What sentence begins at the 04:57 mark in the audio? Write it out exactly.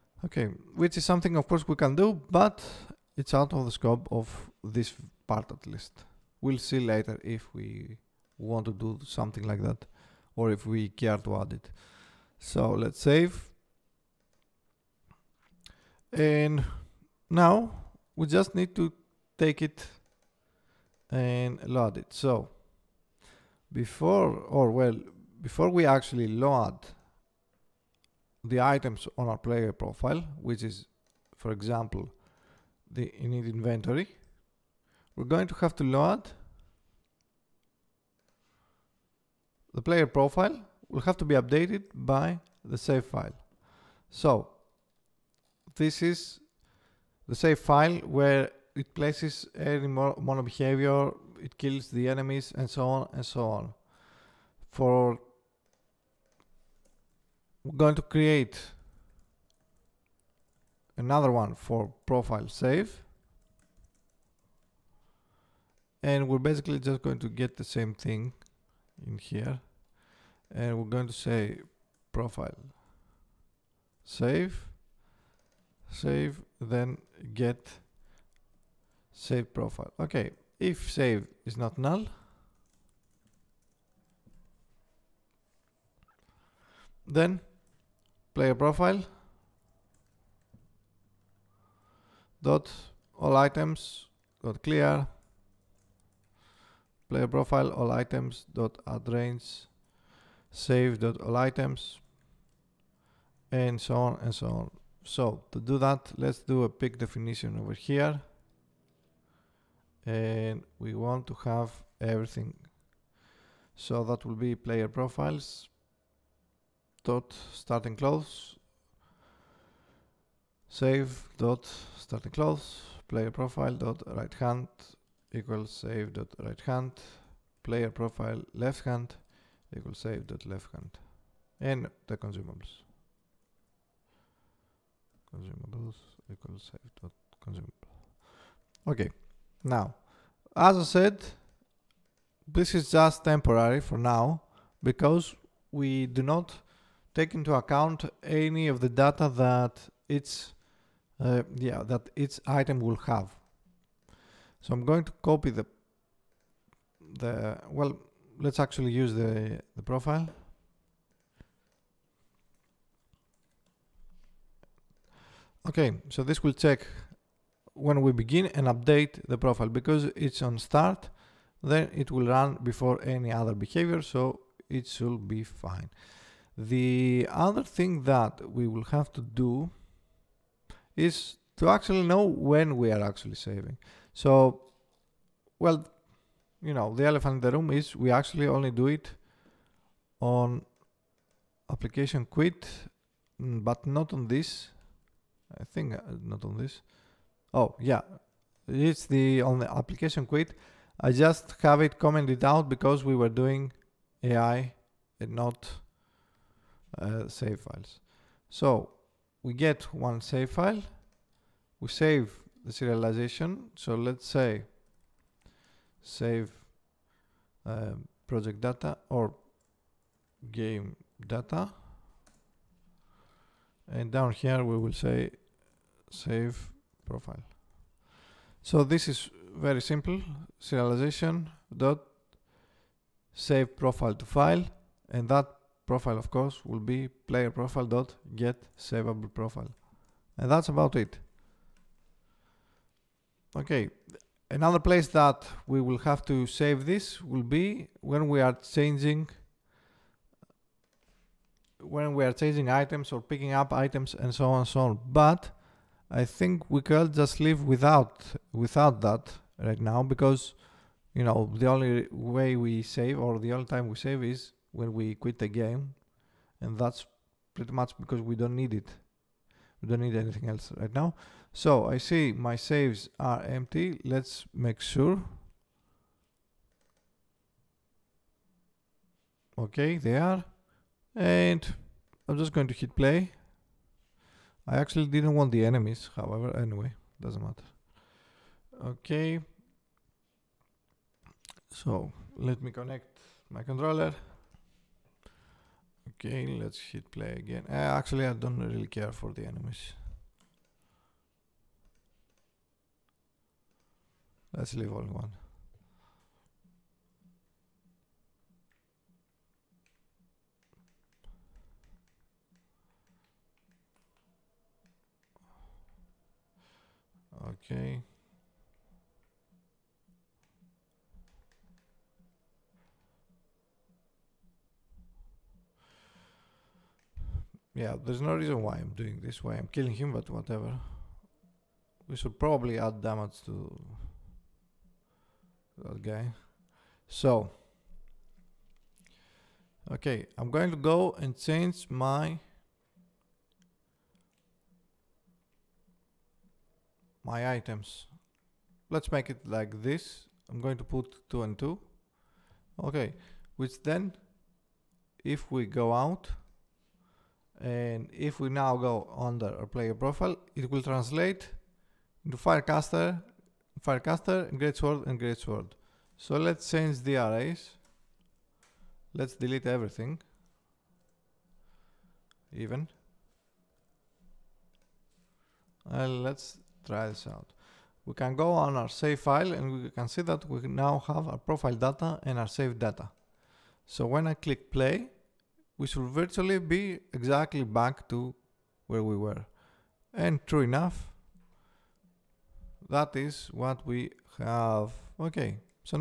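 Uh, actually, I don't really care for the enemies.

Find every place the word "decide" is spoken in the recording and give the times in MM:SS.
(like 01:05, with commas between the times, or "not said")
not said.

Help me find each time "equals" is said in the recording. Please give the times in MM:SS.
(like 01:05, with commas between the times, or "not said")
02:05, 02:09, 02:16.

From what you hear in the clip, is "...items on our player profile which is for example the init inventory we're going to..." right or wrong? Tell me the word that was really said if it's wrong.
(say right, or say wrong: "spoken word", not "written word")
right.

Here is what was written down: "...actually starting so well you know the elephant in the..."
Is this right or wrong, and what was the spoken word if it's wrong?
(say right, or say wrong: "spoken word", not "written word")
wrong: "saving", not "starting".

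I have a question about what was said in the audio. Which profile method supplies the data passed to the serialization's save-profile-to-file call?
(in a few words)
get savable profile.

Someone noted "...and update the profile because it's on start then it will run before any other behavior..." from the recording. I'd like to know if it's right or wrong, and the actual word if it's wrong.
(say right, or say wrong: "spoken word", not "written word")
right.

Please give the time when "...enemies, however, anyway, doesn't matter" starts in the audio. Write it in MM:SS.
04:45.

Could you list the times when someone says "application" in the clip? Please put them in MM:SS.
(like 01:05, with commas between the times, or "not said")
03:11, 03:19.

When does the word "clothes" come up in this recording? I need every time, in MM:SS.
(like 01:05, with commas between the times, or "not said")
01:57, 02:02.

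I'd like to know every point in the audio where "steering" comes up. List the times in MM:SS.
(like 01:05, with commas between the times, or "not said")
not said.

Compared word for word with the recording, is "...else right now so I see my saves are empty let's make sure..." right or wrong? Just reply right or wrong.
right.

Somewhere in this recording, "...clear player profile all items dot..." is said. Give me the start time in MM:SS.
01:34.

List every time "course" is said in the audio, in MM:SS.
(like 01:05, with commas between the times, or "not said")
00:01, 03:56.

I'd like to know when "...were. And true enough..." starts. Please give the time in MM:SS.
06:29.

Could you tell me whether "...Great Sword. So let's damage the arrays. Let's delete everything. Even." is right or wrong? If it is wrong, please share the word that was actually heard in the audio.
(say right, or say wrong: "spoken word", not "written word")
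wrong: "change", not "damage".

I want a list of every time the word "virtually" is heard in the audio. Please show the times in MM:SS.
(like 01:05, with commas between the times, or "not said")
06:26.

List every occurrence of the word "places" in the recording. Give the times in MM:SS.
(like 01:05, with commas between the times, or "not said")
00:48, 04:04.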